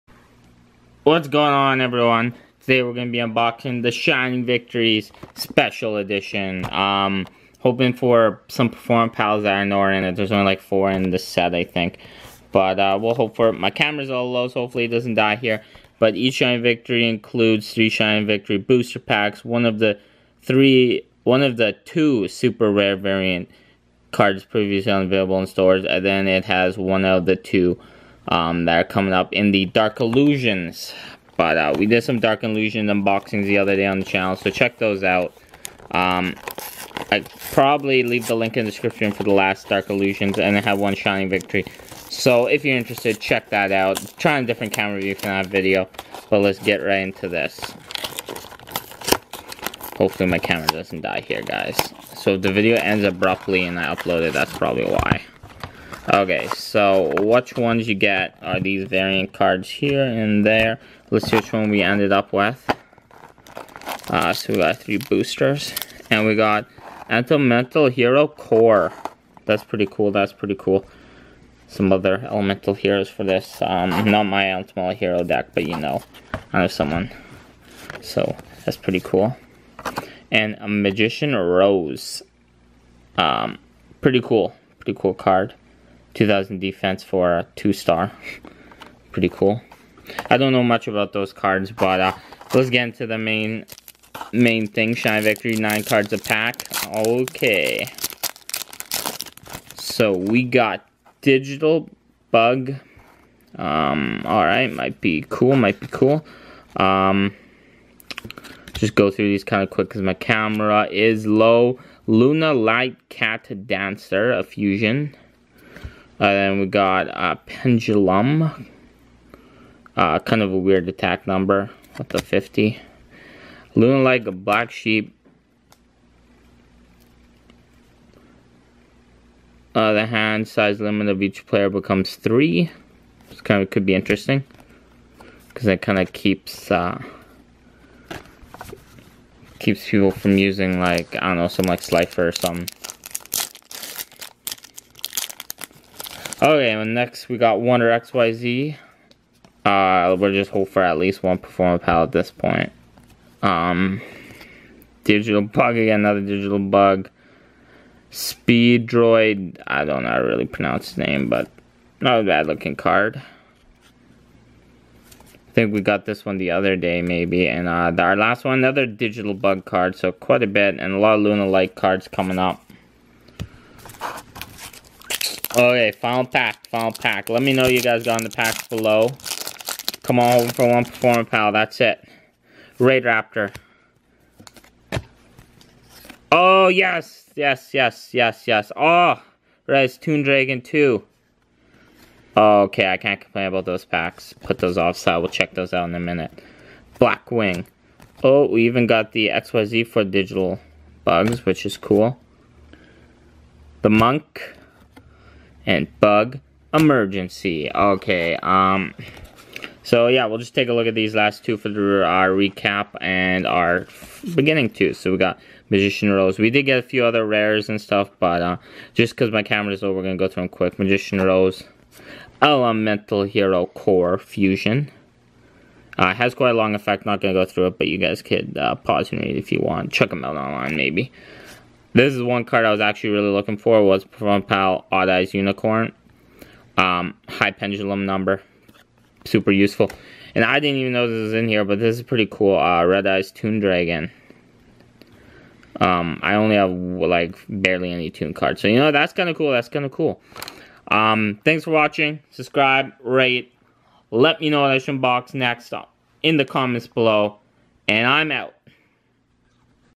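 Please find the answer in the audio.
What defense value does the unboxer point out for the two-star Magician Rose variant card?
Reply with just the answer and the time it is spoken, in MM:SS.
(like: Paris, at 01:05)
2000, at 01:26.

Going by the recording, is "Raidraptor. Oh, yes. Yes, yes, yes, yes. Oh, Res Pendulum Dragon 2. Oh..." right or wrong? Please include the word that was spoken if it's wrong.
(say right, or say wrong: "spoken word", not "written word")
wrong: "Toon", not "Pendulum".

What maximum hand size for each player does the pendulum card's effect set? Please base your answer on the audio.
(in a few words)
3.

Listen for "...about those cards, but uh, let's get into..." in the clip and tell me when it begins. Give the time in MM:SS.
01:30.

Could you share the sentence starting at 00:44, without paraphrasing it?
Try a different camera view for that video, but let's get right into this.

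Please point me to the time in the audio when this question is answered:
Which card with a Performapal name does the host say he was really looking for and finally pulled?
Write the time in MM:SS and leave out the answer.
03:54.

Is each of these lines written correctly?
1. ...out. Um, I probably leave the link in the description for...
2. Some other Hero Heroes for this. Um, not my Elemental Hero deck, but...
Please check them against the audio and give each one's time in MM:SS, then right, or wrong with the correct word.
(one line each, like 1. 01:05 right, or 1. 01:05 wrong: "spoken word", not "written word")
1. 00:35 right
2. 01:11 wrong: "Elemental", not "Hero".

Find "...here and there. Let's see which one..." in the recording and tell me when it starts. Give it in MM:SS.
00:59.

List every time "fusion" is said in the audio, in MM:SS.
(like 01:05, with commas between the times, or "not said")
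01:54, 03:44.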